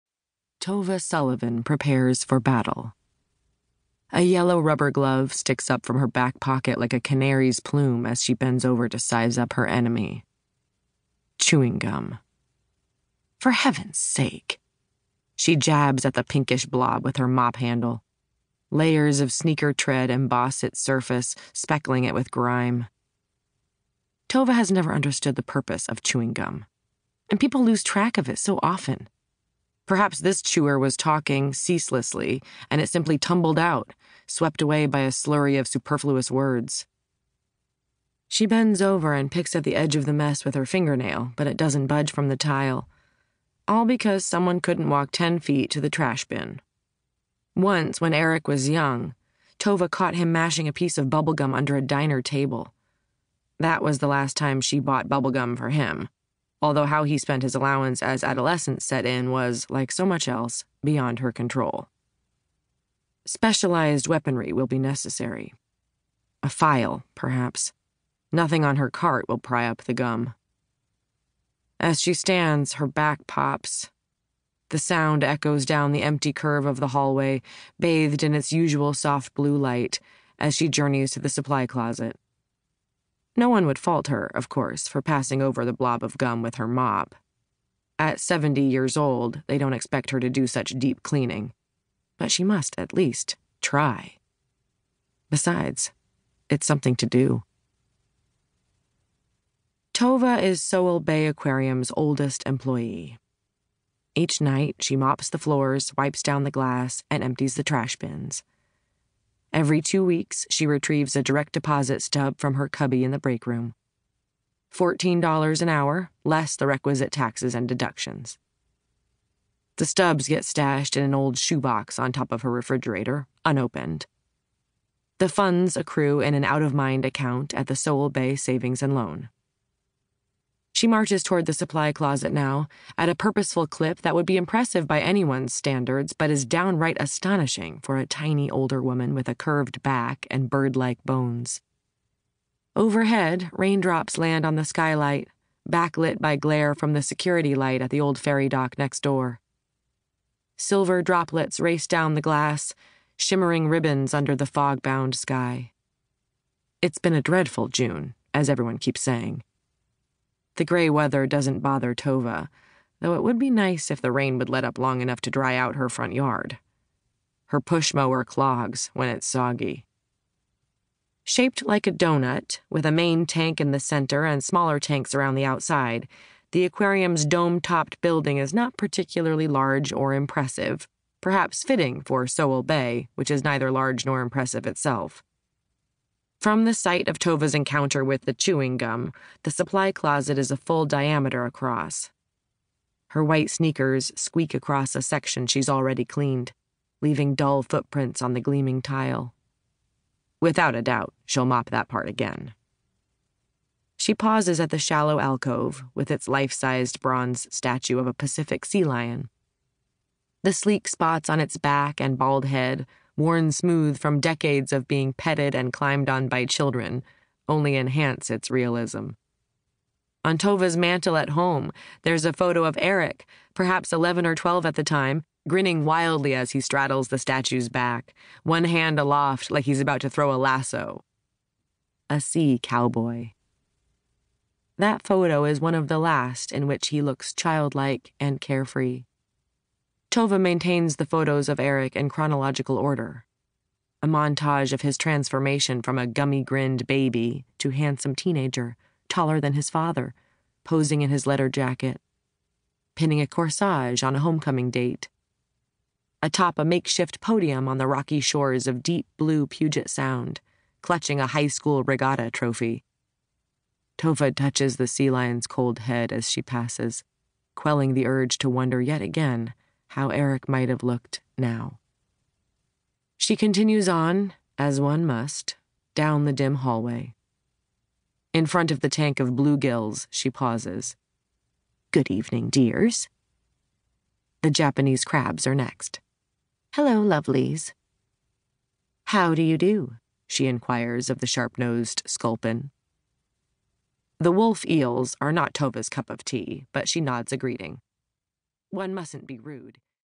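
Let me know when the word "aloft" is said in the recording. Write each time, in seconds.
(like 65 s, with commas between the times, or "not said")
228 s.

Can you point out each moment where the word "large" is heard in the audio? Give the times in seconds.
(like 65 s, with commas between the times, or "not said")
179 s, 183 s.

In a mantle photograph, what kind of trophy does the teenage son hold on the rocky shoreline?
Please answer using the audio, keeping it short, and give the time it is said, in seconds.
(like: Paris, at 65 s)
regatta trophy, at 261 s.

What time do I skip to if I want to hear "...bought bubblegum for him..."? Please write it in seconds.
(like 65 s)
54 s.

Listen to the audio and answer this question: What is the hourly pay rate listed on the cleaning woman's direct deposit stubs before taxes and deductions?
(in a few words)
$14.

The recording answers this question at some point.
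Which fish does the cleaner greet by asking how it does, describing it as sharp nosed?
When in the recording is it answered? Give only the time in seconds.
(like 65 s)
292 s.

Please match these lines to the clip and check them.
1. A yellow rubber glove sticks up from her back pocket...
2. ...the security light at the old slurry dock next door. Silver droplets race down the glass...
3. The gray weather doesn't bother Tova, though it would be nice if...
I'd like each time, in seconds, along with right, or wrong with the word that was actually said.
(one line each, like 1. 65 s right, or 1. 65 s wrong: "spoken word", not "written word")
1. 4 s right
2. 146 s wrong: "ferry", not "slurry"
3. 160 s right.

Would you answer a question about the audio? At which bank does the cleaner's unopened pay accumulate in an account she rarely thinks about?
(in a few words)
Sowell Bay Savings and Loan.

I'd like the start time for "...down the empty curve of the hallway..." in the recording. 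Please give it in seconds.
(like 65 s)
75 s.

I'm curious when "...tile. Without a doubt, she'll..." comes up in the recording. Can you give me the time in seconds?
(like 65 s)
198 s.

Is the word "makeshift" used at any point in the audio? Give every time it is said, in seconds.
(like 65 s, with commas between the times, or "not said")
256 s.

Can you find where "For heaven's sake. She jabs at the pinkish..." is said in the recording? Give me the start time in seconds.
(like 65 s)
13 s.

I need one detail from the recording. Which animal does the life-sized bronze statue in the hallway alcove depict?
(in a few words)
Pacific sea lion.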